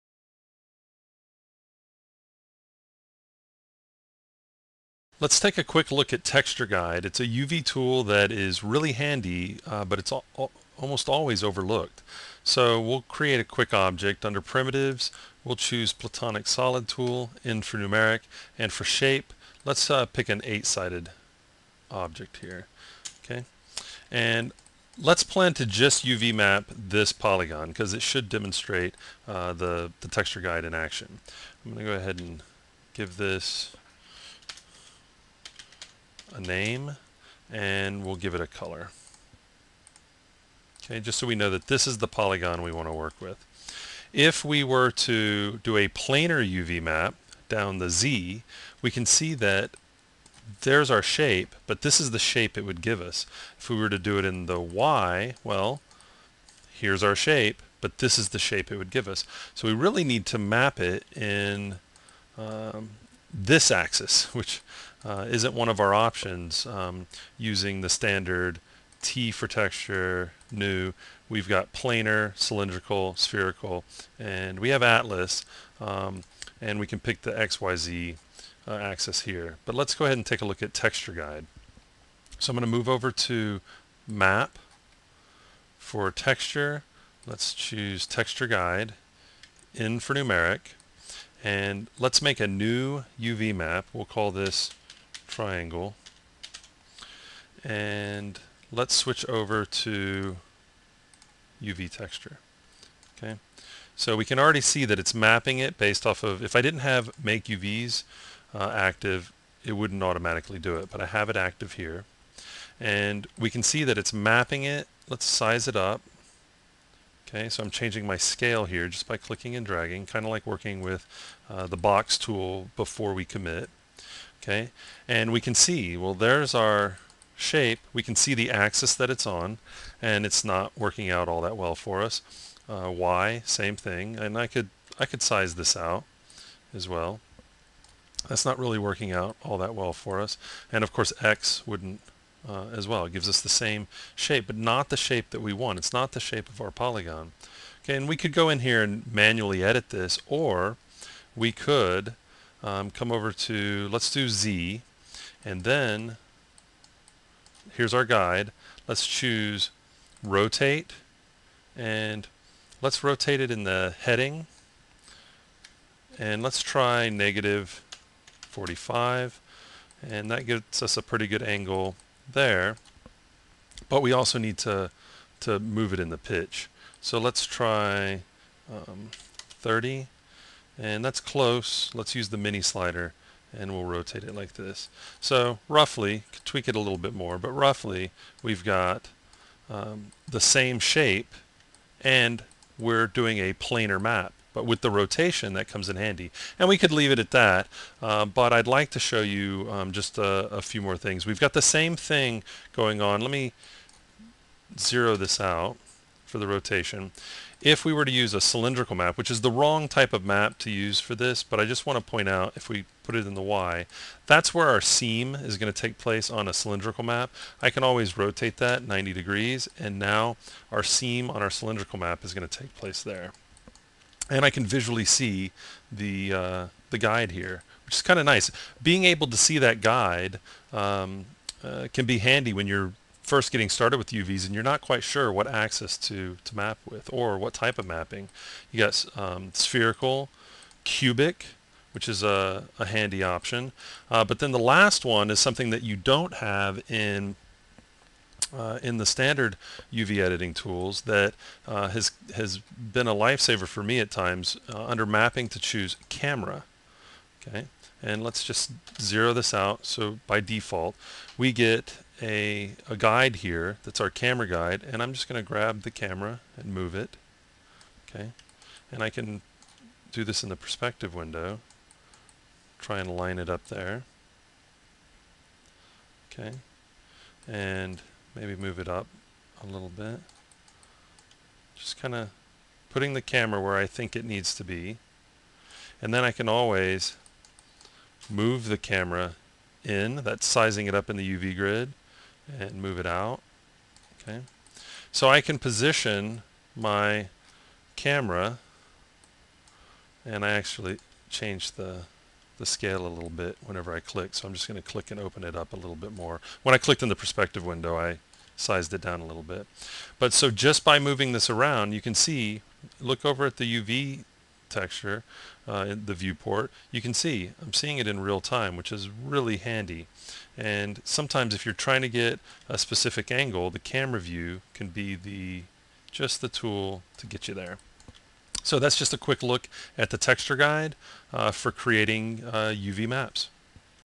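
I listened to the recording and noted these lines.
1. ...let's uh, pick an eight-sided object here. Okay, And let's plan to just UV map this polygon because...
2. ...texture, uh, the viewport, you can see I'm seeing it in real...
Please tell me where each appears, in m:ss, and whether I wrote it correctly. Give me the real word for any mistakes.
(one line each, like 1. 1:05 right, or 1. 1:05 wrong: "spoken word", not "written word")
1. 0:19 right
2. 5:14 right.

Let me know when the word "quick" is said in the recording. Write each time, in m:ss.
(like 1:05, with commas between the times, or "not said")
0:05, 0:13, 5:29.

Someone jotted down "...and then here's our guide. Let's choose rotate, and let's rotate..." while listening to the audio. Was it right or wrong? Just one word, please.
right.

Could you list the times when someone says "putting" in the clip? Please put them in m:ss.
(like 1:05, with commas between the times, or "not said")
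4:42.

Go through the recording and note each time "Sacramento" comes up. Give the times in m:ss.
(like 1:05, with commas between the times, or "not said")
not said.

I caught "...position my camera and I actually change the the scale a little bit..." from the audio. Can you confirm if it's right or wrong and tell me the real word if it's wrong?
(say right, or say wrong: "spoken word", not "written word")
right.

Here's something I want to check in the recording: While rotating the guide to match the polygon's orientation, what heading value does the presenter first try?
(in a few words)
-45.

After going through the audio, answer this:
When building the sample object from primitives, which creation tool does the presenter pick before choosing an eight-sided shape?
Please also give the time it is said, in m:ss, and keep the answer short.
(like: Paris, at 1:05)
Platonic Solid Tool, at 0:15.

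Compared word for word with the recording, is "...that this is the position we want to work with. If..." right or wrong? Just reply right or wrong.
wrong.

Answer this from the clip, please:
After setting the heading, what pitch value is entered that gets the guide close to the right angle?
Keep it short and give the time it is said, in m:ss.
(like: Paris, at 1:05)
30, at 2:59.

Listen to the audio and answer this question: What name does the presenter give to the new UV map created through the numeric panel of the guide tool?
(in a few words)
triangle.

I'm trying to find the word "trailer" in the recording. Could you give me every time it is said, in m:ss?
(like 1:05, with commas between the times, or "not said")
not said.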